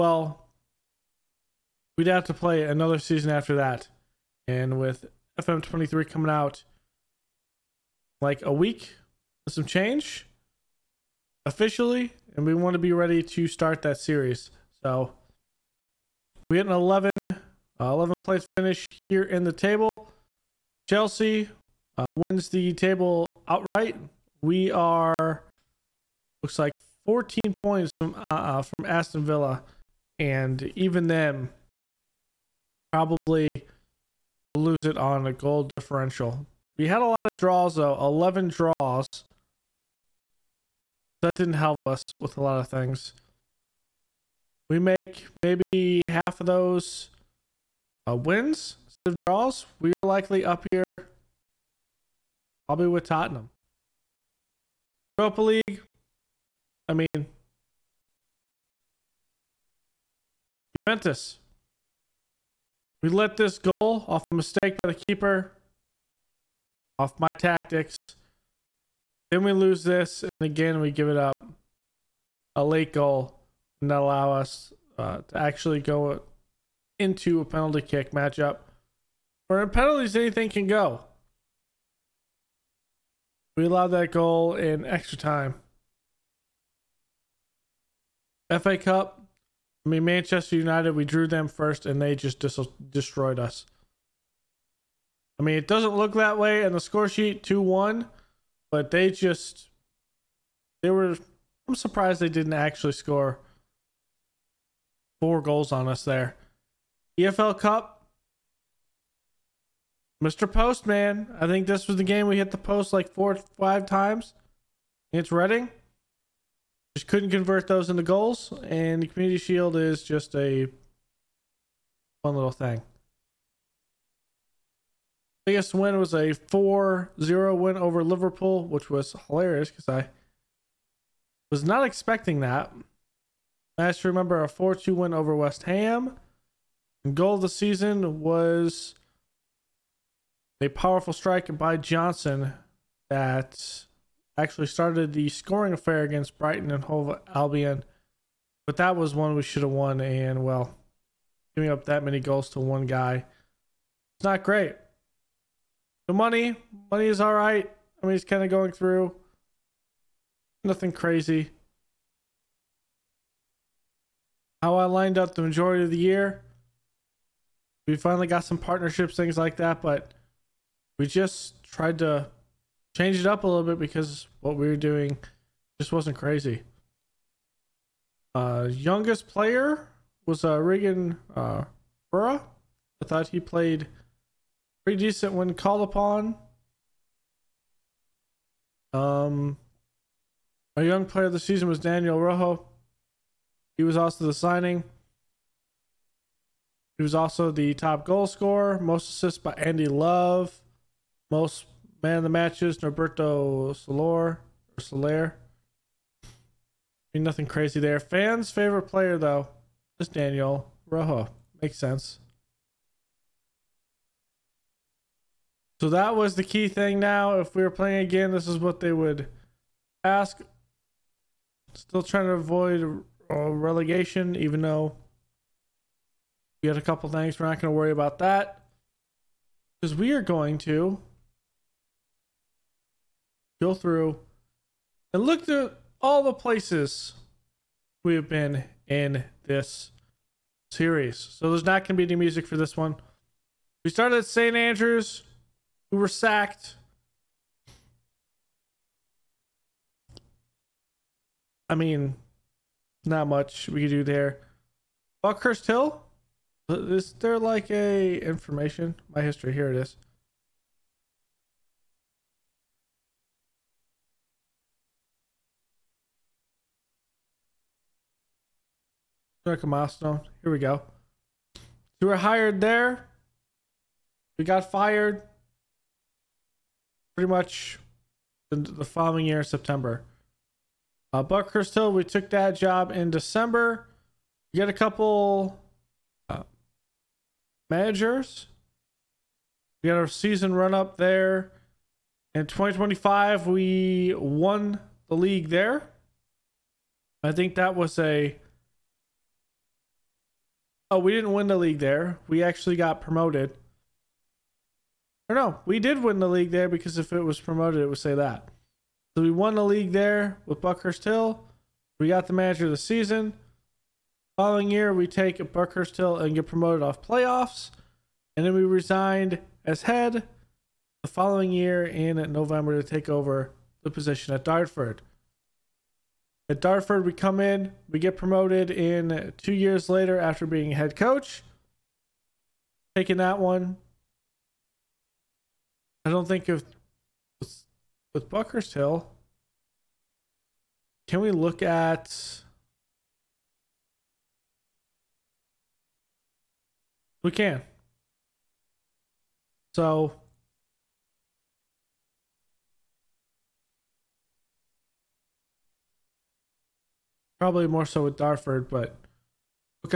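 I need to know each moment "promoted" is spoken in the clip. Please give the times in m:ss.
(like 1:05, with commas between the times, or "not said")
5:03, 5:07, 5:16, 5:28.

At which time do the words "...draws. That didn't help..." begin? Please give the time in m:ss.
0:38.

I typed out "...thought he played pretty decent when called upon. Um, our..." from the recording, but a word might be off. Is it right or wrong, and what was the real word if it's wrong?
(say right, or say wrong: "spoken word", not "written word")
right.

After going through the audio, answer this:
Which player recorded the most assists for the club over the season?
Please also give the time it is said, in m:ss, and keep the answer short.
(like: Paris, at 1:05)
Andy Love, at 3:19.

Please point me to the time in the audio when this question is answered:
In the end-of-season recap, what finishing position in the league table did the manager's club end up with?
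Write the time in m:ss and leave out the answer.
0:17.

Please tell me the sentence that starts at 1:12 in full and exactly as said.
A late goal, and allow us uh, to actually go into a penalty kick matchup where penalties anything can go.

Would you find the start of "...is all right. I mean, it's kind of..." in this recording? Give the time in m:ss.
2:37.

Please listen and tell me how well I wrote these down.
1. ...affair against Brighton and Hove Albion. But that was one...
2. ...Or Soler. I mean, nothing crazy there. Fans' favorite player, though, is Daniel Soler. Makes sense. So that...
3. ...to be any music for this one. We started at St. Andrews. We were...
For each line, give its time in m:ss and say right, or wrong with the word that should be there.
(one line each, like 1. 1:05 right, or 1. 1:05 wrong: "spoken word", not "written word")
1. 2:25 right
2. 3:24 wrong: "Rojo", not "Soler"
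3. 4:01 right.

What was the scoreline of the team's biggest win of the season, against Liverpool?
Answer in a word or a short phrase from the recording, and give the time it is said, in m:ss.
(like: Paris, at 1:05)
4-0, at 2:06.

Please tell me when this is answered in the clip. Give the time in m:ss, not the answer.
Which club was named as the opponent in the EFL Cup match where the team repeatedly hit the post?
1:55.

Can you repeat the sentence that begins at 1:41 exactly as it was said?
I'm surprised they didn't actually score four goals on us there.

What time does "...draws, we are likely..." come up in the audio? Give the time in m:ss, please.
0:49.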